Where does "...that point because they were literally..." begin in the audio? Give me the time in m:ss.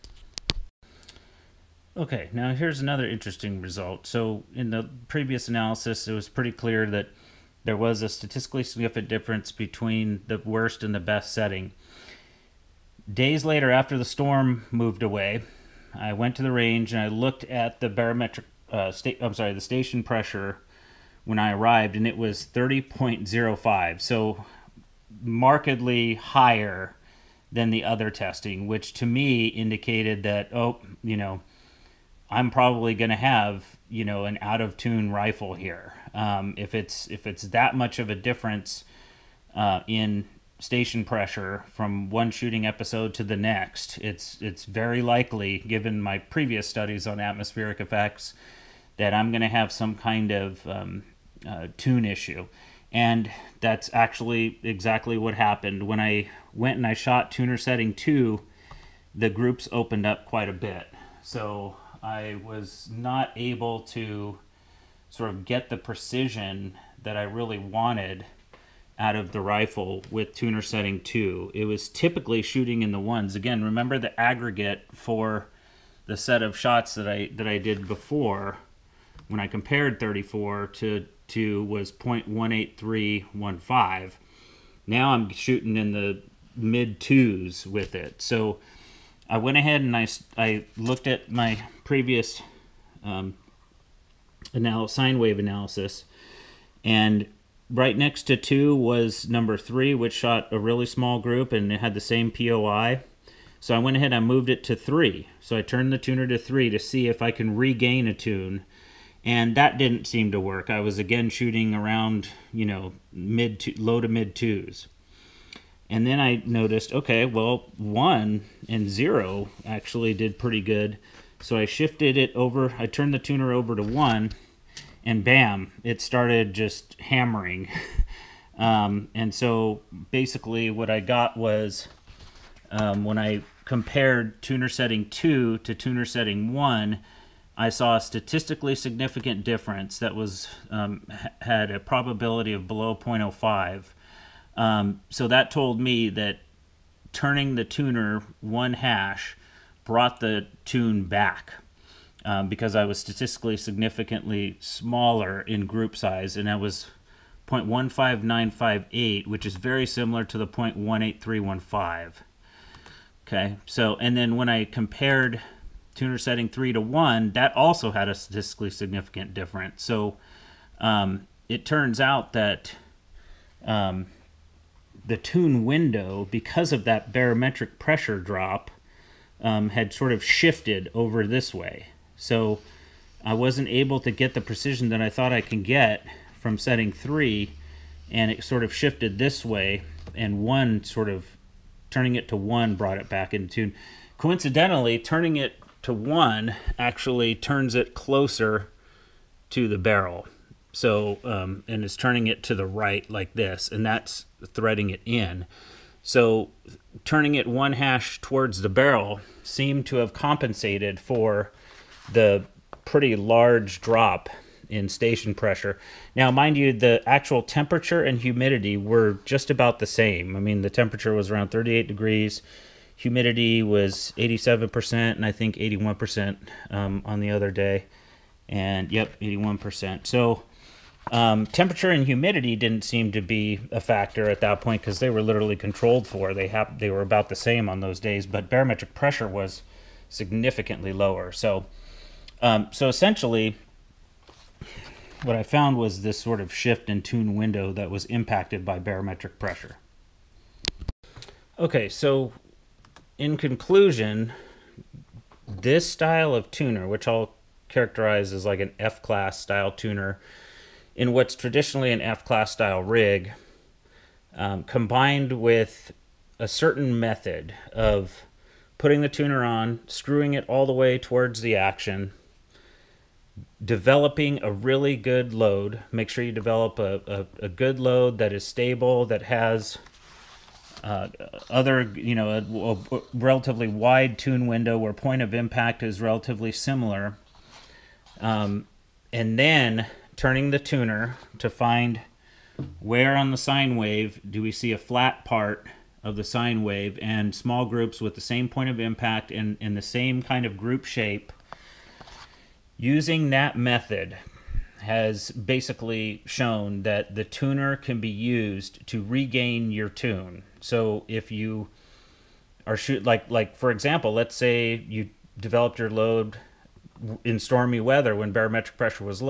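3:54.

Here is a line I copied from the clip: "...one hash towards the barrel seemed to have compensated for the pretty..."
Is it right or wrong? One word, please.
right.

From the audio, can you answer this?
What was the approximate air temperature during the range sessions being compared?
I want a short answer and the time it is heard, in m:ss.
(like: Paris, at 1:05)
38 degrees, at 3:41.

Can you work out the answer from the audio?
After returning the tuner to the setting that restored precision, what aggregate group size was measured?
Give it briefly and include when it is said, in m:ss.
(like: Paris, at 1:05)
0.15958, at 2:37.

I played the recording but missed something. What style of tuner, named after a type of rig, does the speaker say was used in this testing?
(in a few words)
F-class style tuner.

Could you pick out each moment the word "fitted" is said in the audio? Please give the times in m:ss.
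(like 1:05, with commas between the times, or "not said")
not said.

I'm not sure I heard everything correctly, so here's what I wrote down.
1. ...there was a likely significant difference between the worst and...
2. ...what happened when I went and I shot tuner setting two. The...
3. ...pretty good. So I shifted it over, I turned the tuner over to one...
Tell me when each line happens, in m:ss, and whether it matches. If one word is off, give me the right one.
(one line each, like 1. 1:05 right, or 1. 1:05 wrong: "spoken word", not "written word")
1. 0:07 wrong: "statistically", not "likely"
2. 0:55 right
3. 2:00 right.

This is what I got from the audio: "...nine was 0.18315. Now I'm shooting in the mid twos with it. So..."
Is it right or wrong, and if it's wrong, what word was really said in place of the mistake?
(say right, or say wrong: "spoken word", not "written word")
wrong: "two", not "nine".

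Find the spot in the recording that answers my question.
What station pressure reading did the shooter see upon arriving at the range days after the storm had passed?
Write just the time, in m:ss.
0:22.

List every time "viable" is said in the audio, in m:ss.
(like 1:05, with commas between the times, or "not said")
not said.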